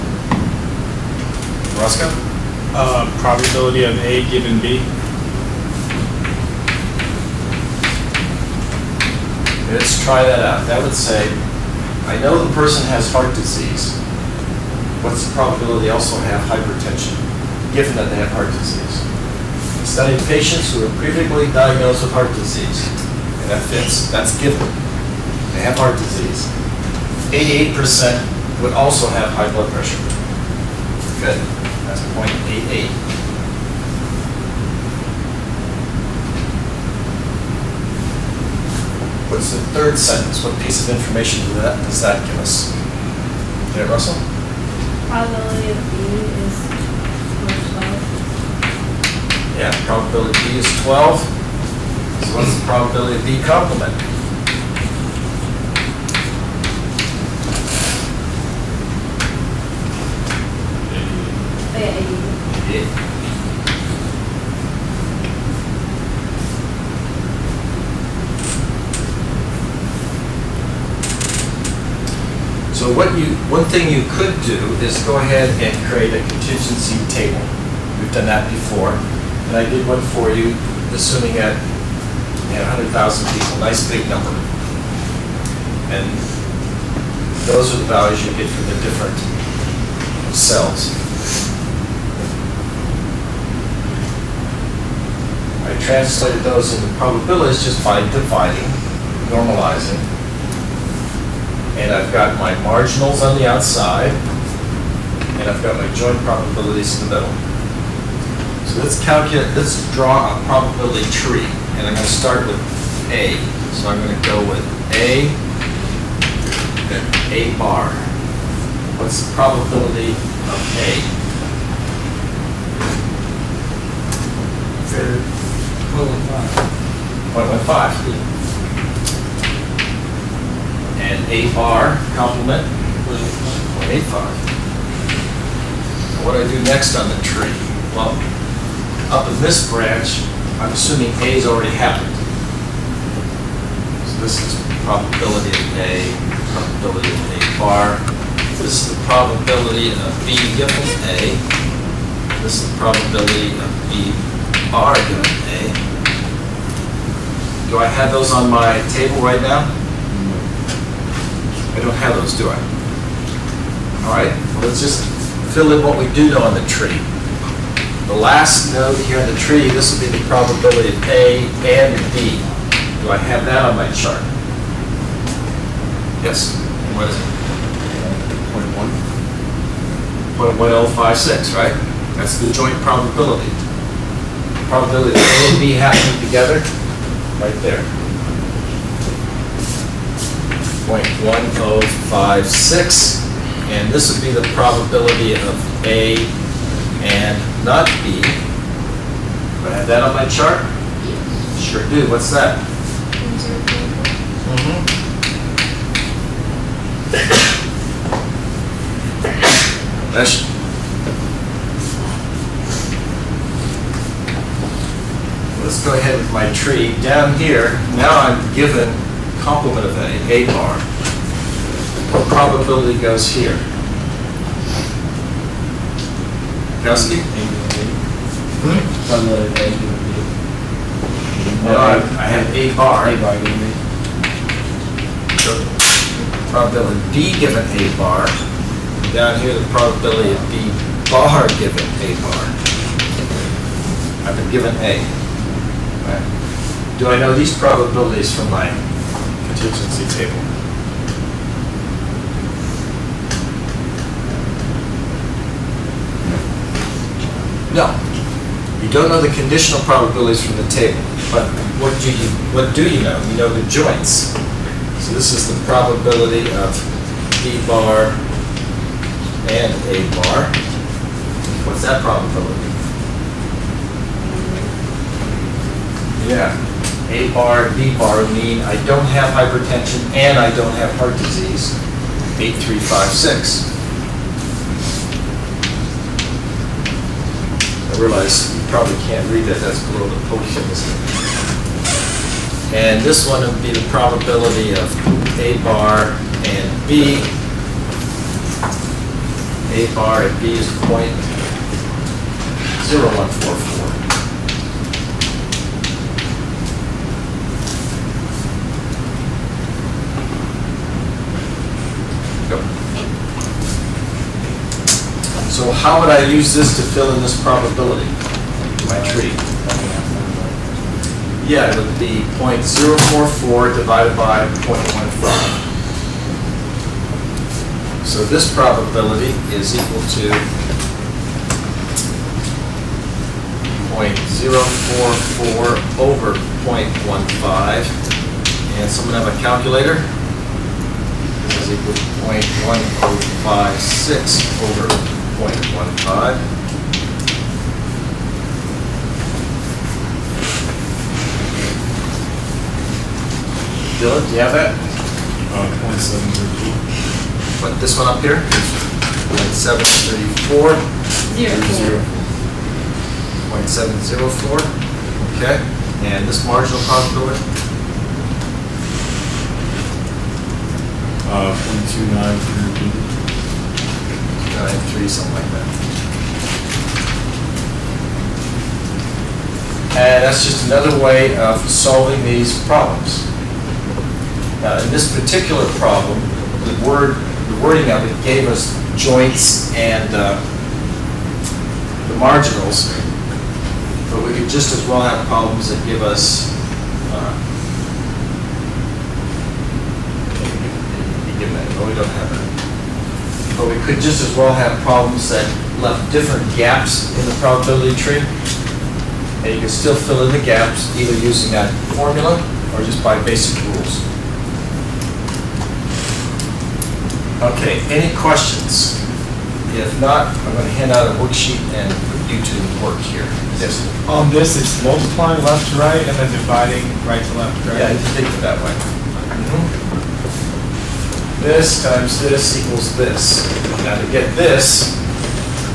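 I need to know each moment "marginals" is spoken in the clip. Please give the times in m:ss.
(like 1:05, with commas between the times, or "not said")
1:42, 6:06, 6:32.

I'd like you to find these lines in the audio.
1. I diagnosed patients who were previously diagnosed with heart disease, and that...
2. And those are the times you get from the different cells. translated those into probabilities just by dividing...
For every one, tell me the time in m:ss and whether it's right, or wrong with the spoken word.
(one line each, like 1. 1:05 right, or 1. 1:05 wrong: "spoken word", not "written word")
1. 0:19 wrong: "studied", not "diagnosed"
2. 1:25 wrong: "values", not "times".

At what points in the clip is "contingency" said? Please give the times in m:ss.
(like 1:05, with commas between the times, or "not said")
1:16, 4:09.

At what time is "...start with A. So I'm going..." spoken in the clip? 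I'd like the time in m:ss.
1:52.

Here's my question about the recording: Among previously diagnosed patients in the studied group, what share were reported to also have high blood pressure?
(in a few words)
88%.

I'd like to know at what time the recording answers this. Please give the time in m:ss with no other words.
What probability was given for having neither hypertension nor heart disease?
4:42.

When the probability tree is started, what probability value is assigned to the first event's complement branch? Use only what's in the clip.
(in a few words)
0.85.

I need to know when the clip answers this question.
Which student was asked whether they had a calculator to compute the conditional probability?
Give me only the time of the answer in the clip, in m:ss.
5:53.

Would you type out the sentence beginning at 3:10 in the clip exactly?
0.1056, and this would be the probability of A and not B.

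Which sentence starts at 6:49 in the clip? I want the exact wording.
And you can still fill in the gaps either using that formula or just by basic rules.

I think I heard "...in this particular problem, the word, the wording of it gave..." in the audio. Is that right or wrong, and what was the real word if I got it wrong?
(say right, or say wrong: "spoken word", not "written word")
right.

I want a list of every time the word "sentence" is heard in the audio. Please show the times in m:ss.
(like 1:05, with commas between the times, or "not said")
0:39.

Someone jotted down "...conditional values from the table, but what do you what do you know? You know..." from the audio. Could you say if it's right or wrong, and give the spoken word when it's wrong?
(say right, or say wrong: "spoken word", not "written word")
wrong: "probabilities", not "values".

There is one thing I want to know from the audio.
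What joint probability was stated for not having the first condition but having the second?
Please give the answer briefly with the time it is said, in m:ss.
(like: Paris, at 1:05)
0.0145, at 5:00.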